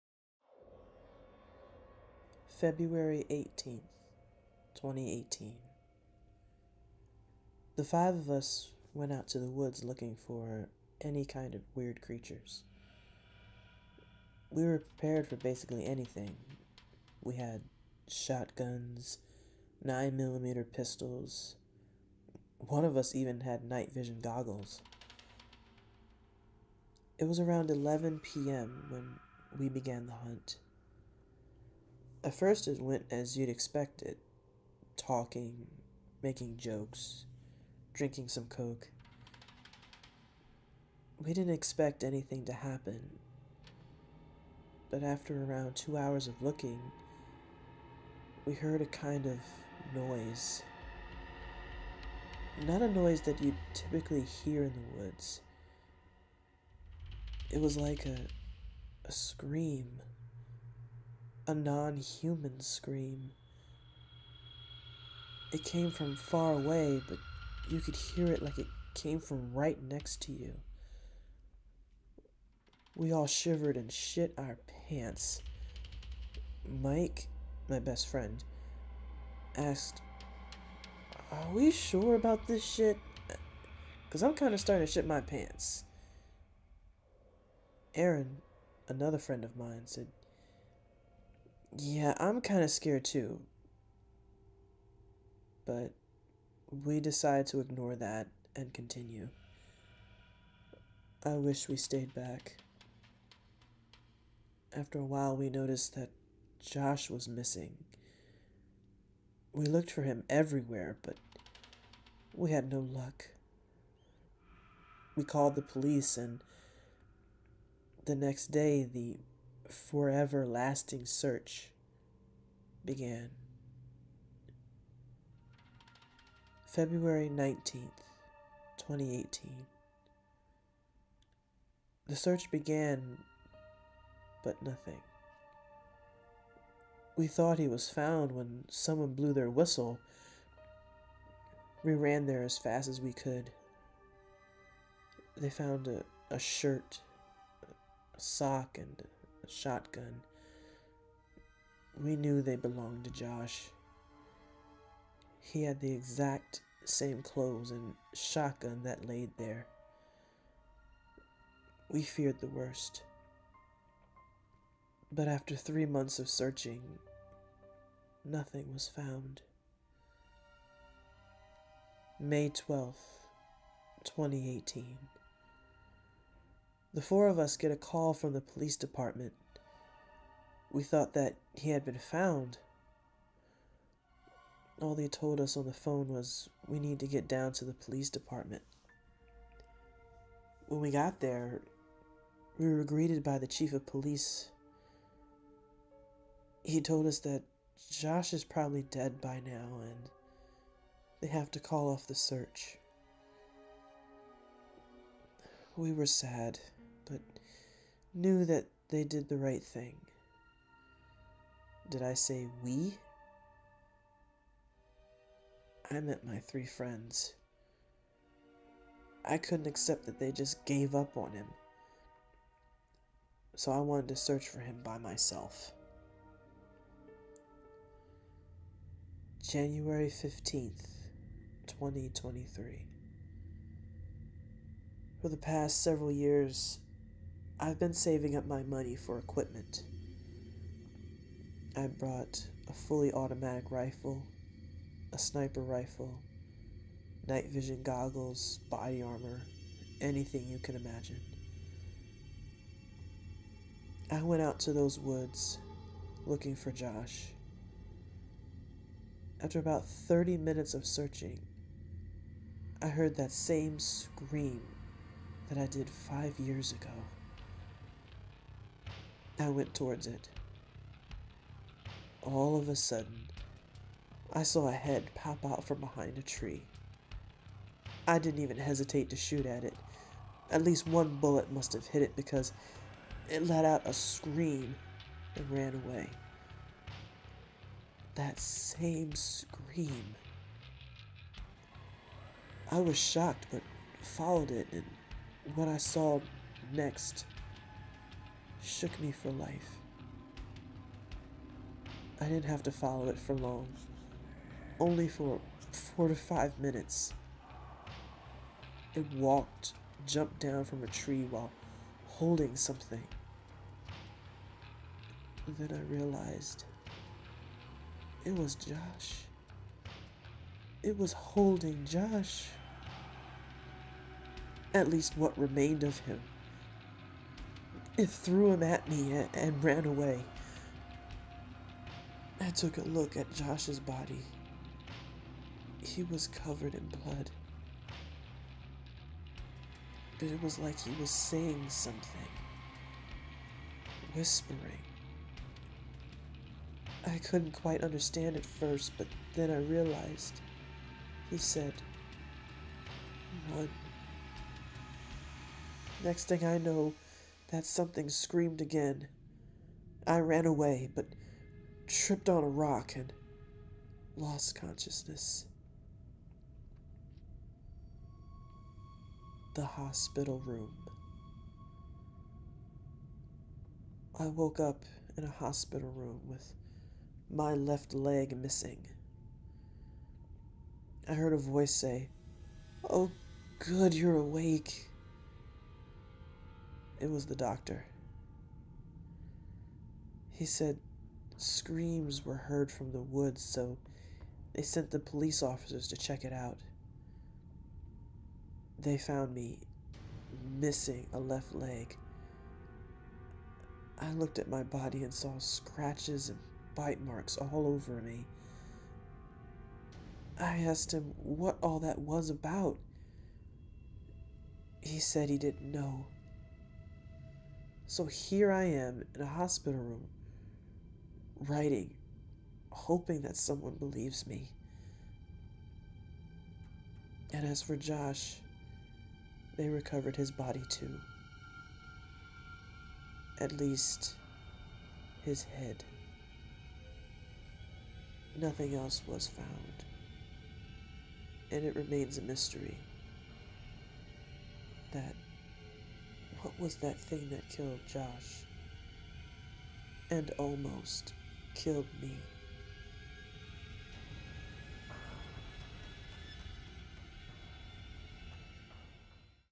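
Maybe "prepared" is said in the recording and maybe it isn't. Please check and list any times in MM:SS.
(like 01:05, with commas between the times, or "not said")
00:14.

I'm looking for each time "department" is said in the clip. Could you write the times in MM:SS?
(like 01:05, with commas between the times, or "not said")
02:58, 03:08.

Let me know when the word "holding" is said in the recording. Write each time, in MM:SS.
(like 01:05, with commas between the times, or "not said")
05:12, 05:21.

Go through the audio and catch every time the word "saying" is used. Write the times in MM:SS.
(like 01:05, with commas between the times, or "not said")
05:41.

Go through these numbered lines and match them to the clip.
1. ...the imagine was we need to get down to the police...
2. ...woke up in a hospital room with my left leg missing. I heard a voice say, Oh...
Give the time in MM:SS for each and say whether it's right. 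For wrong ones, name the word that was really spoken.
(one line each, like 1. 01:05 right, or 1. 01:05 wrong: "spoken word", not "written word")
1. 03:05 wrong: "phone", not "imagine"
2. 06:14 right.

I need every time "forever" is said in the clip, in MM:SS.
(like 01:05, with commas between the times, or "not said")
01:59.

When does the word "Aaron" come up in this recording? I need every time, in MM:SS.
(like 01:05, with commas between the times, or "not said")
01:27.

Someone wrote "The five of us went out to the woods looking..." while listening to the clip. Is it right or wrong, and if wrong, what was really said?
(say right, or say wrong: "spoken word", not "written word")
right.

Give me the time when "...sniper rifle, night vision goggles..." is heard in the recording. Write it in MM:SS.
04:05.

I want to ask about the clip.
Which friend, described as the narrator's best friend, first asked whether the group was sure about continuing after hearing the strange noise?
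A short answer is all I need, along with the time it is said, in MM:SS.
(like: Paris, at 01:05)
Mike, at 01:16.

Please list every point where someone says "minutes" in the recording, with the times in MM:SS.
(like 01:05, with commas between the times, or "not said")
04:20, 05:06.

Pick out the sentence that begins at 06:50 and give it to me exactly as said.
I asked him what all that was about.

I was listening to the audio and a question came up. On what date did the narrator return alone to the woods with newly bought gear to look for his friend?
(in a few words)
January 15th, 2023.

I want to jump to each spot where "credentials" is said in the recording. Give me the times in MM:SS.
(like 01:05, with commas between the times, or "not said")
not said.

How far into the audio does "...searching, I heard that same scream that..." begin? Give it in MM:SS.
04:20.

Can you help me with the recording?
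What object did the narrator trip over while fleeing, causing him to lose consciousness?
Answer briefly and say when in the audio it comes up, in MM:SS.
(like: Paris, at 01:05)
a rock, at 06:02.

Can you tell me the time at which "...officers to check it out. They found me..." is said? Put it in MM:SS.
06:35.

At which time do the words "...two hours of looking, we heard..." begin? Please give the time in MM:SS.
00:45.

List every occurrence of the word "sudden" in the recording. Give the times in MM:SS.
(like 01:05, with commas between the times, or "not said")
04:32.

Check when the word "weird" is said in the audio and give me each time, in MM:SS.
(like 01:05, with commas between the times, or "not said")
00:11.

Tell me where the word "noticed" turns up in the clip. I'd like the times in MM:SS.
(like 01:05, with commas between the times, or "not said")
01:45.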